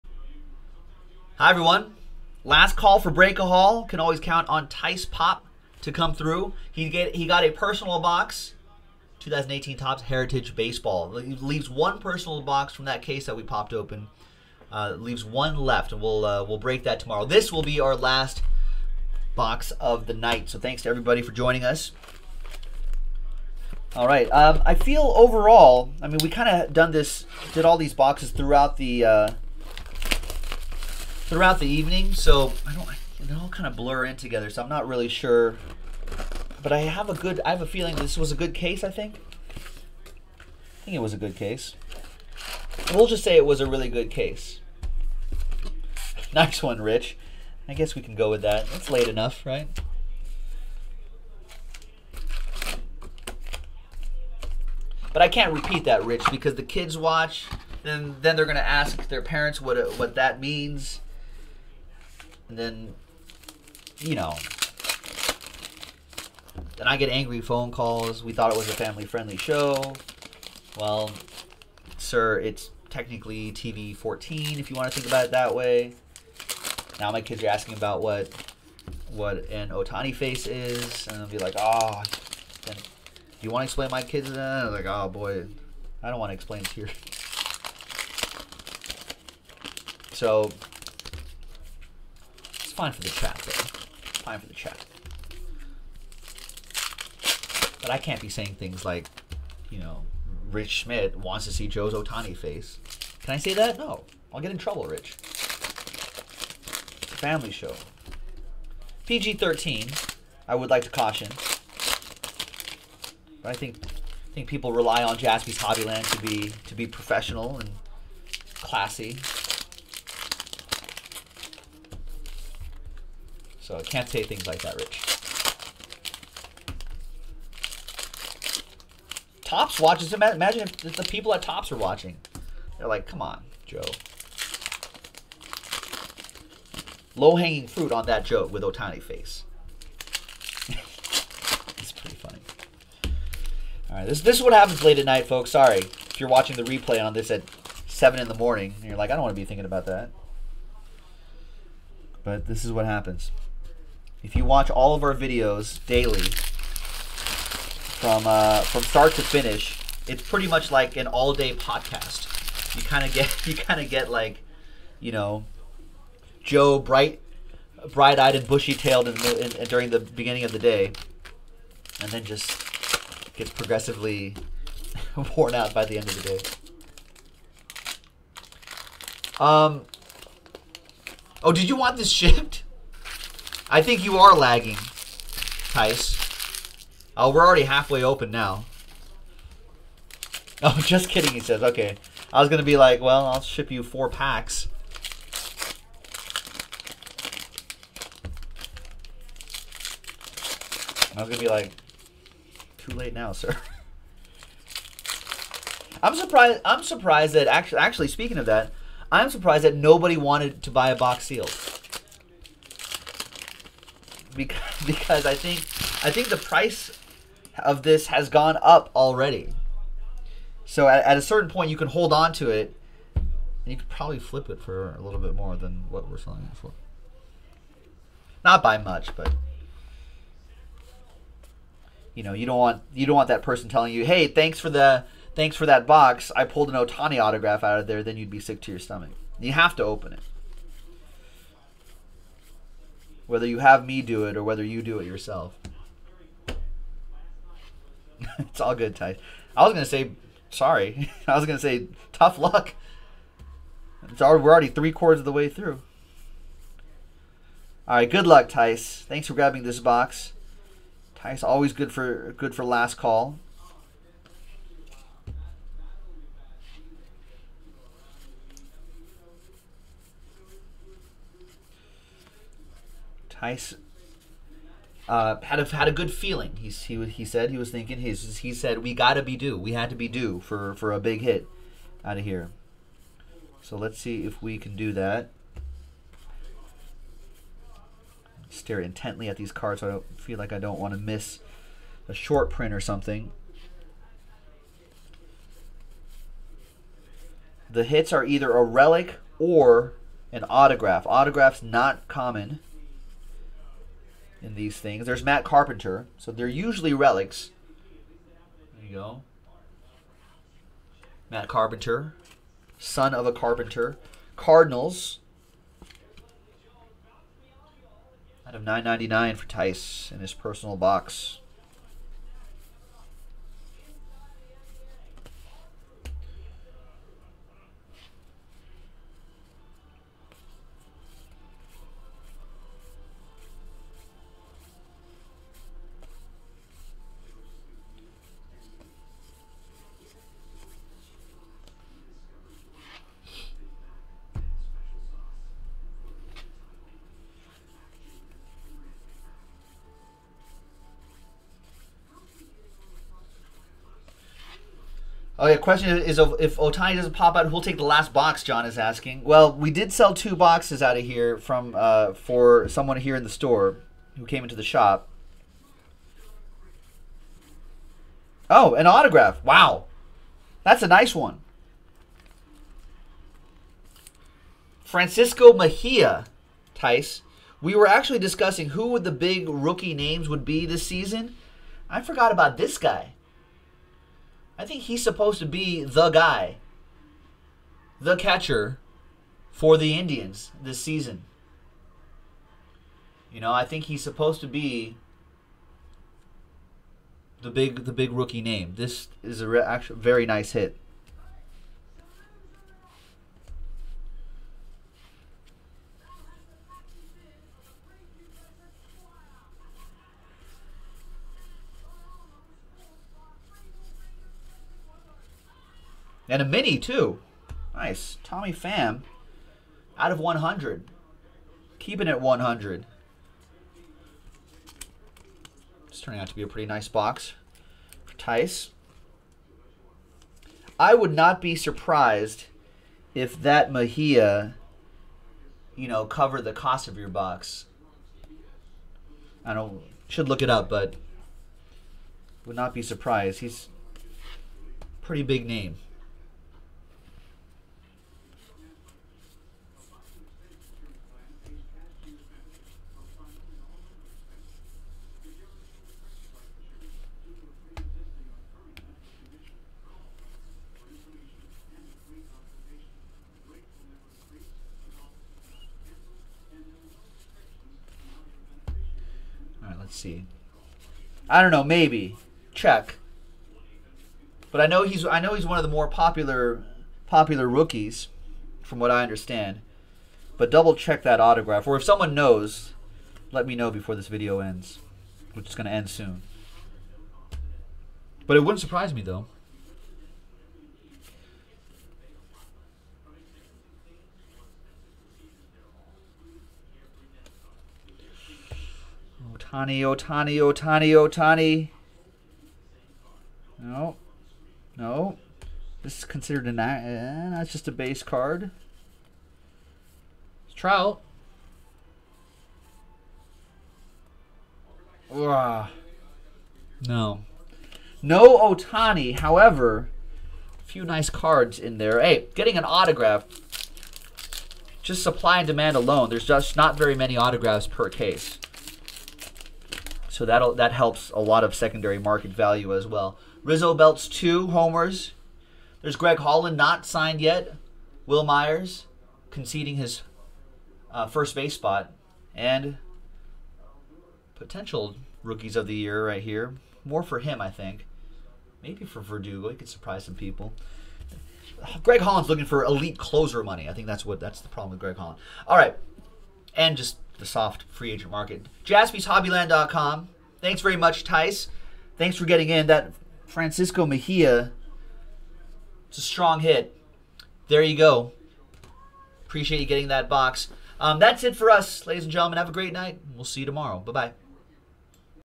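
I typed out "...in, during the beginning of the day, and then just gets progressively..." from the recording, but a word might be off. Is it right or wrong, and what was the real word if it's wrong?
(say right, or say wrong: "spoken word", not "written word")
right.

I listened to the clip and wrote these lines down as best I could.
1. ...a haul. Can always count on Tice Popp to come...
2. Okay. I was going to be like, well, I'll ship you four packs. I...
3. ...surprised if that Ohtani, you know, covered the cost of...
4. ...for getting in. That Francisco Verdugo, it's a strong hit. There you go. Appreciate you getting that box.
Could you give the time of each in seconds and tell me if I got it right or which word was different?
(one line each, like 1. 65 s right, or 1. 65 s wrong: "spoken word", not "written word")
1. 3 s right
2. 191 s right
3. 431 s wrong: "Mejia", not "Ohtani"
4. 562 s wrong: "Mejia", not "Verdugo".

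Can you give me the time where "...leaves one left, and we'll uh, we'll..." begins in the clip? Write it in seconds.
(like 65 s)
14 s.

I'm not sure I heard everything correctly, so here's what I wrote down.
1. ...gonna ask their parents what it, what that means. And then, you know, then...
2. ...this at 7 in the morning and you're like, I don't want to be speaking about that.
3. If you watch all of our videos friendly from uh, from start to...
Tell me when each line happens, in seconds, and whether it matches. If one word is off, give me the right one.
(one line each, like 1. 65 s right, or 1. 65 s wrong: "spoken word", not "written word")
1. 58 s right
2. 147 s wrong: "thinking", not "speaking"
3. 154 s wrong: "daily", not "friendly".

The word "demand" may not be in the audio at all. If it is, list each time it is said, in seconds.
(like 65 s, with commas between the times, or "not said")
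525 s.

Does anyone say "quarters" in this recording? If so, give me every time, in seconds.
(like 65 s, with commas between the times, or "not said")
254 s.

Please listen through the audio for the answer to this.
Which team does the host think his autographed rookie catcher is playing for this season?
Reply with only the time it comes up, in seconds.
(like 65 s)
389 s.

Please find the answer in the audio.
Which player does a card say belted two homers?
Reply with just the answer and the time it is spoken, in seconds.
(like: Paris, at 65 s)
Rizzo, at 533 s.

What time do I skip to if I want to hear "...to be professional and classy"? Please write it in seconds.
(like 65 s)
116 s.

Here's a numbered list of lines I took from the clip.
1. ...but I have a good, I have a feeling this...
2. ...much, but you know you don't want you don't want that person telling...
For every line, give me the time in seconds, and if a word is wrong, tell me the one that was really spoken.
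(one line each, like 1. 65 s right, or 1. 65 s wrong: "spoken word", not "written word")
1. 36 s right
2. 228 s right.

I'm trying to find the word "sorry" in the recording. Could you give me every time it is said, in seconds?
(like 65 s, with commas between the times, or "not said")
145 s, 250 s.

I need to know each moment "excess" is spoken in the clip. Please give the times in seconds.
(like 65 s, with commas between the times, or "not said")
not said.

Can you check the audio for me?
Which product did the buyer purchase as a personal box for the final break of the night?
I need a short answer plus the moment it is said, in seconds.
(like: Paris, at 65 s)
2018 Topps Heritage Baseball, at 9 s.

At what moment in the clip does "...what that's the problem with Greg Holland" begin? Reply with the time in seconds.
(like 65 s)
554 s.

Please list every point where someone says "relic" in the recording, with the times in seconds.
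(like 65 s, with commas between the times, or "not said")
298 s, 306 s.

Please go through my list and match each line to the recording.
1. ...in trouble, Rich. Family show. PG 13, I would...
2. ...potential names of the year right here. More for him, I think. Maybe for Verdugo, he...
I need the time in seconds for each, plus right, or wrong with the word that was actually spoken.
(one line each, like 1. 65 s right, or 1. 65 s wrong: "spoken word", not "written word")
1. 104 s right
2. 544 s wrong: "rookies", not "names".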